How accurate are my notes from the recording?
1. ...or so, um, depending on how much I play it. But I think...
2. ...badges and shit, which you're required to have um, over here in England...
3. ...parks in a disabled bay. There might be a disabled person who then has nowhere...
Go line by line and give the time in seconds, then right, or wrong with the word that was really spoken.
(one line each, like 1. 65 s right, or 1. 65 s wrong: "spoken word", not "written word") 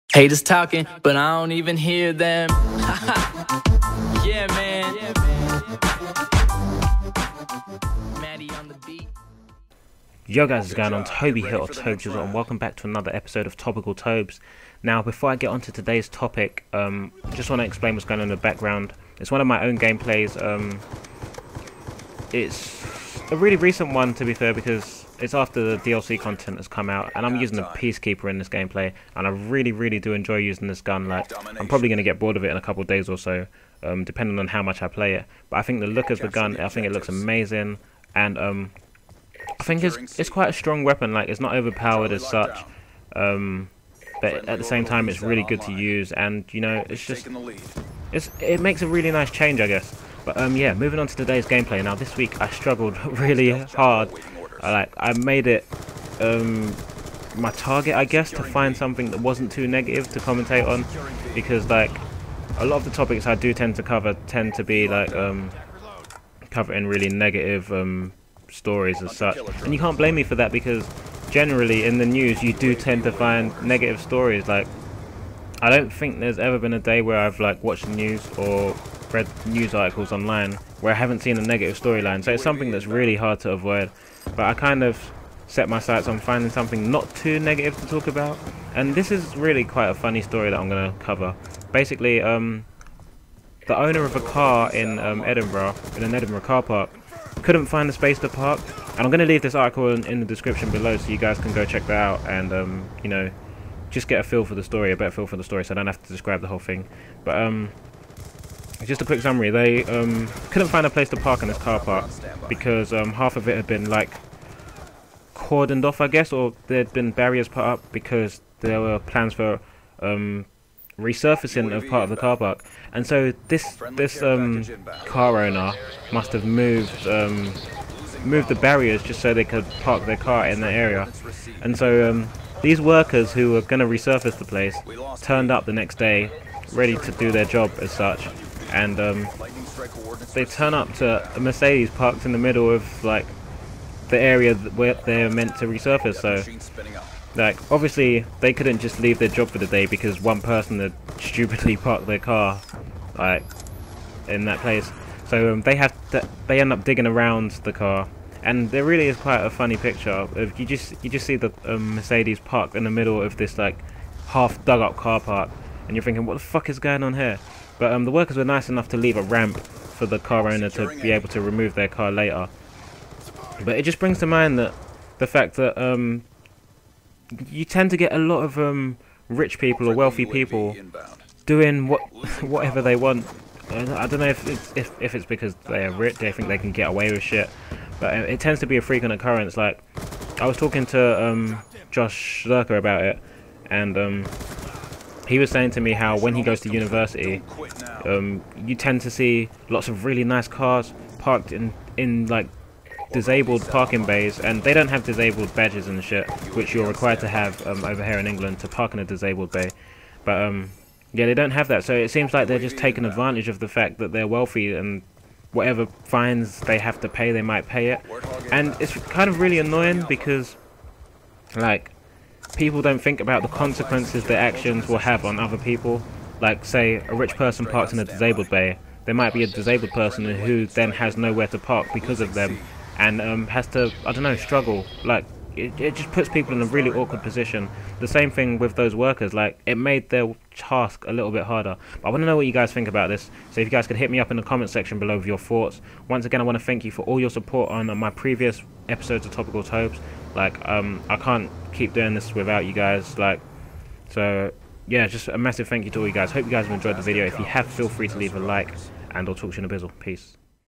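1. 33 s right
2. 205 s right
3. 227 s right.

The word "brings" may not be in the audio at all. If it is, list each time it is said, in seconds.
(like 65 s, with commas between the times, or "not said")
173 s.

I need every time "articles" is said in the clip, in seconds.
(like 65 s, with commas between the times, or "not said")
79 s, 99 s.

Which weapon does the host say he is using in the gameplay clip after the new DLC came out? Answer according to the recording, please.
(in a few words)
Peacekeeper.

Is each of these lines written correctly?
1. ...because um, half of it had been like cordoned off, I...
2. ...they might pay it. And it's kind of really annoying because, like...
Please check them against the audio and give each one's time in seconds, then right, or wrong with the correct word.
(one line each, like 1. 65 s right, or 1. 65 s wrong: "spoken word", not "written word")
1. 112 s right
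2. 217 s right.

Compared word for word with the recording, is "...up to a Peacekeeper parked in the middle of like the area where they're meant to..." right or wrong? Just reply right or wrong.
wrong.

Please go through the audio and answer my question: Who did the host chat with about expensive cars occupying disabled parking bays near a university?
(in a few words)
Josh Zerkaa.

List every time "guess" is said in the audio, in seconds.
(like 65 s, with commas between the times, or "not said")
49 s, 58 s, 116 s.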